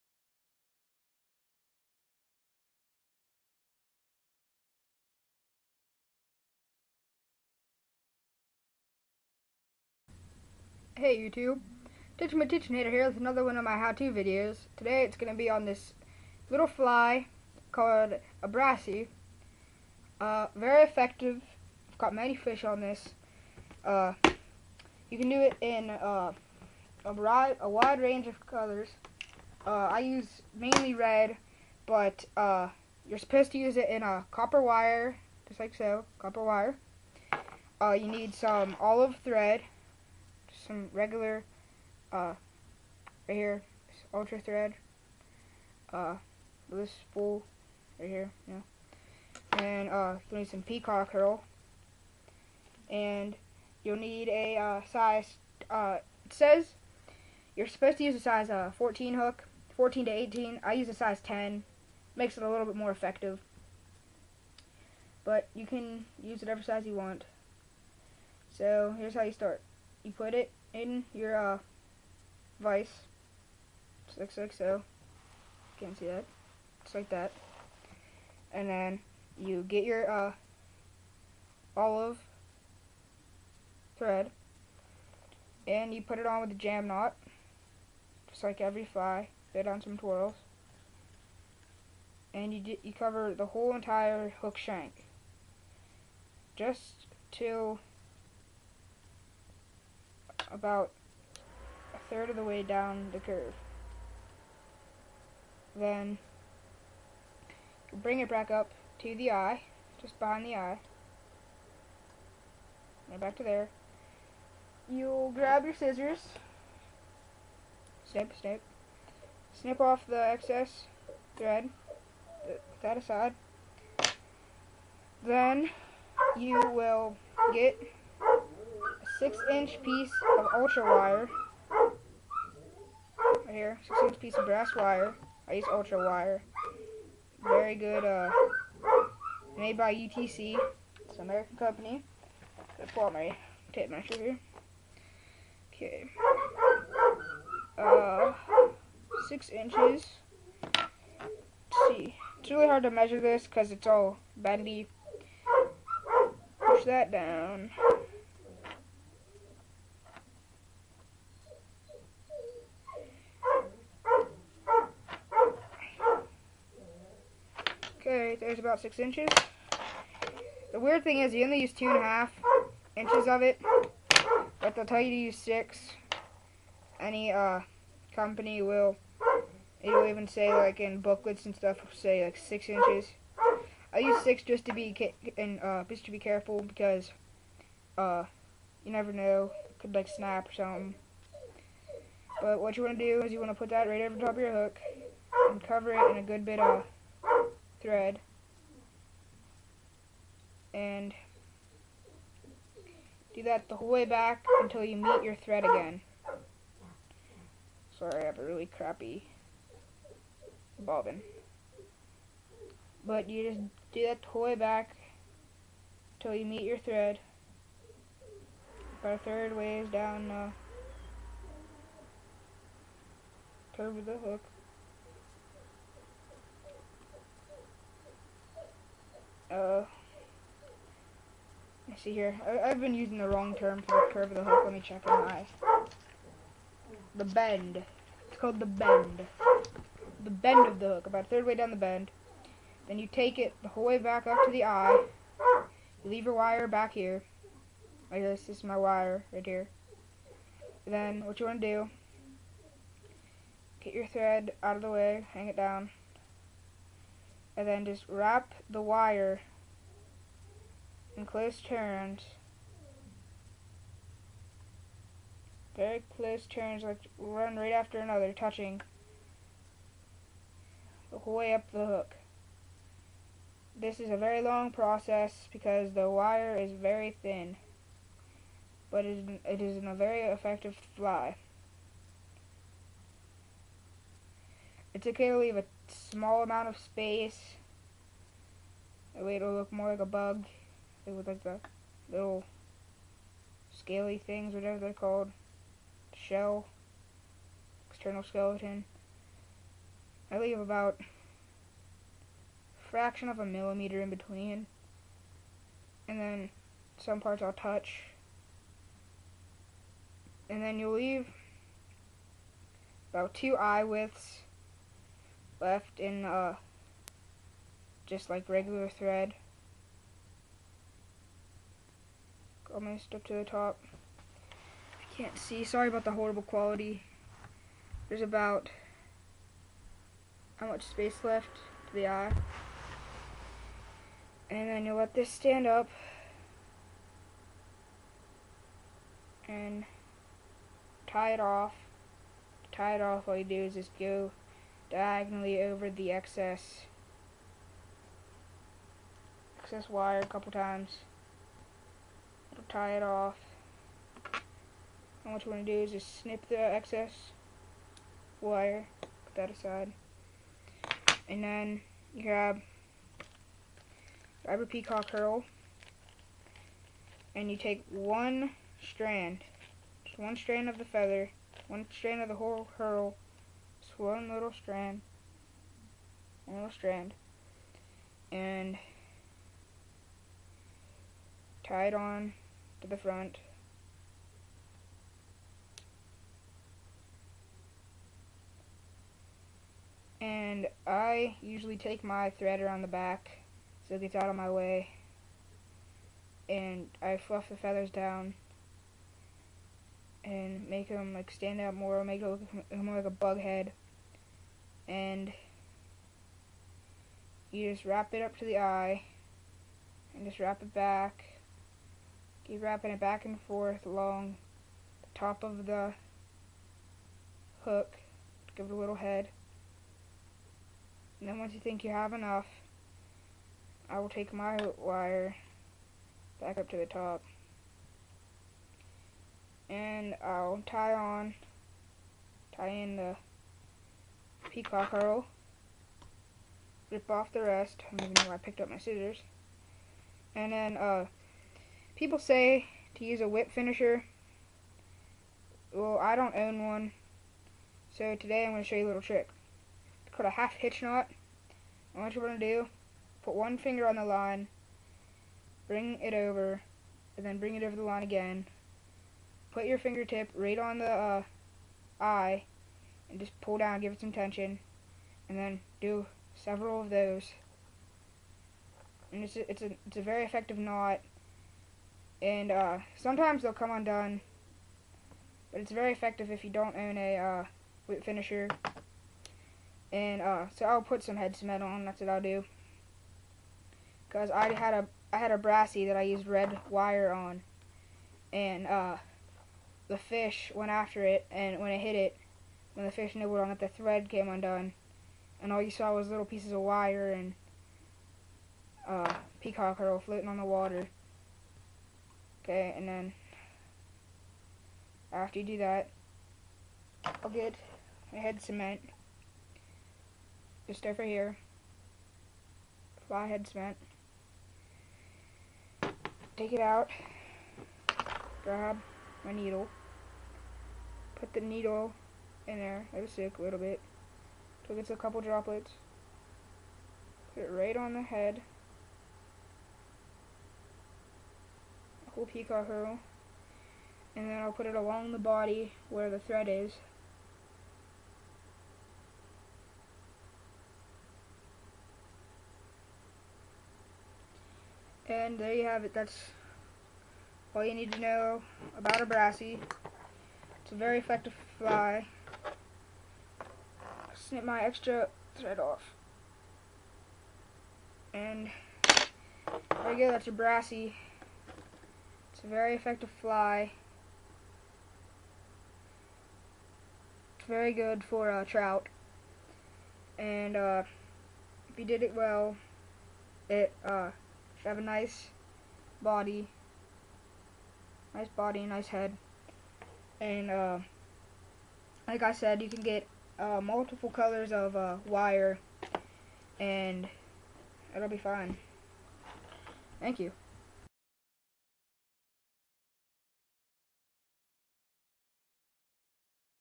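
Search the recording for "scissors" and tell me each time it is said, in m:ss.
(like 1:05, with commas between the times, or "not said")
1:55, 7:18.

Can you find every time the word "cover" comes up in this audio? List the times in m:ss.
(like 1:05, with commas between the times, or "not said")
1:32, 3:15.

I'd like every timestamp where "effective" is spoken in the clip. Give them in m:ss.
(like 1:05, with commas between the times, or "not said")
0:20, 1:02, 4:40, 7:50, 7:55, 9:10, 9:22.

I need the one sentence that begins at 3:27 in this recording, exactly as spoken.
Sorry, I have a really crappy bobbin.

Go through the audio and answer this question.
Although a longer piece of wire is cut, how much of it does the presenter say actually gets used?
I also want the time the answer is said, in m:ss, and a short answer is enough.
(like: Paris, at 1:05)
2.5 inches, at 2:51.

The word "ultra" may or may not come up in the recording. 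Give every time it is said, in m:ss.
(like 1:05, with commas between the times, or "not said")
0:44, 2:10, 2:15.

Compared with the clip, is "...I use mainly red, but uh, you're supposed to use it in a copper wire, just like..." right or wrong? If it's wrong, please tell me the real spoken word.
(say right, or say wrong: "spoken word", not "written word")
right.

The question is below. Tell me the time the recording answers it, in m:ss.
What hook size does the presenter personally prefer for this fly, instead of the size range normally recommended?
1:00.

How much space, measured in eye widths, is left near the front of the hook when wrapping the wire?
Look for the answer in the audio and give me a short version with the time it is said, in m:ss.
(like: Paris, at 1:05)
2 eye widths, at 5:13.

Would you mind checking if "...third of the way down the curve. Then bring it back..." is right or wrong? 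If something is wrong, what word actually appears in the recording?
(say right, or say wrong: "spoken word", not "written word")
right.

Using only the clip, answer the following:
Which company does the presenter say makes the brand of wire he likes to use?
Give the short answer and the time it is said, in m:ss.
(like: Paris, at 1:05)
UTC, at 2:19.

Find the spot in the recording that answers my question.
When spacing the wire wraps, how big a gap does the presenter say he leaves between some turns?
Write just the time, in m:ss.
5:02.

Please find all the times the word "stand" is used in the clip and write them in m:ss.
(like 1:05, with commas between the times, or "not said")
5:35, 6:41.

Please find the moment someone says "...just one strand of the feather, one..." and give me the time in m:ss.
6:10.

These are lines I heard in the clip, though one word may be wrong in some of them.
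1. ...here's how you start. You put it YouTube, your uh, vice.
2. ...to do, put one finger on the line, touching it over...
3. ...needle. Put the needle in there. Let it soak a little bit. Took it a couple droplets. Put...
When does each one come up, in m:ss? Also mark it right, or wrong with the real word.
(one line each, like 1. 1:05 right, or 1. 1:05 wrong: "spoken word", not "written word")
1. 1:08 wrong: "Aiden", not "YouTube"
2. 7:32 wrong: "bring", not "touching"
3. 8:39 right.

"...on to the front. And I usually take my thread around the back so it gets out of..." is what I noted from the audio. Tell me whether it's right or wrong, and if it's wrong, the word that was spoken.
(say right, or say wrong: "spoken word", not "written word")
right.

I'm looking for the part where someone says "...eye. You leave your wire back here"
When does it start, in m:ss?
4:04.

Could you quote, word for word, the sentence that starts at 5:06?
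And then some parts I'll touch.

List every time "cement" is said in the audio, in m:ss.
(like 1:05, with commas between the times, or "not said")
8:01, 8:28, 8:33.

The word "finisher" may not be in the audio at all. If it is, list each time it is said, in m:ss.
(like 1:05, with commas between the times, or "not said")
7:23, 7:58.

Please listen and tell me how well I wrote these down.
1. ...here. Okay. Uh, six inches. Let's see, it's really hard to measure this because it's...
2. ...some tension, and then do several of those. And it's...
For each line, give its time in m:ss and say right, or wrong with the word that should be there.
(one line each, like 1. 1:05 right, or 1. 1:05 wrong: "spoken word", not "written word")
1. 2:24 right
2. 7:43 right.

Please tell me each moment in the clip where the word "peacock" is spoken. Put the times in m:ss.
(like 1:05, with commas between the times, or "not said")
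0:50, 6:04, 7:14, 8:19, 8:52.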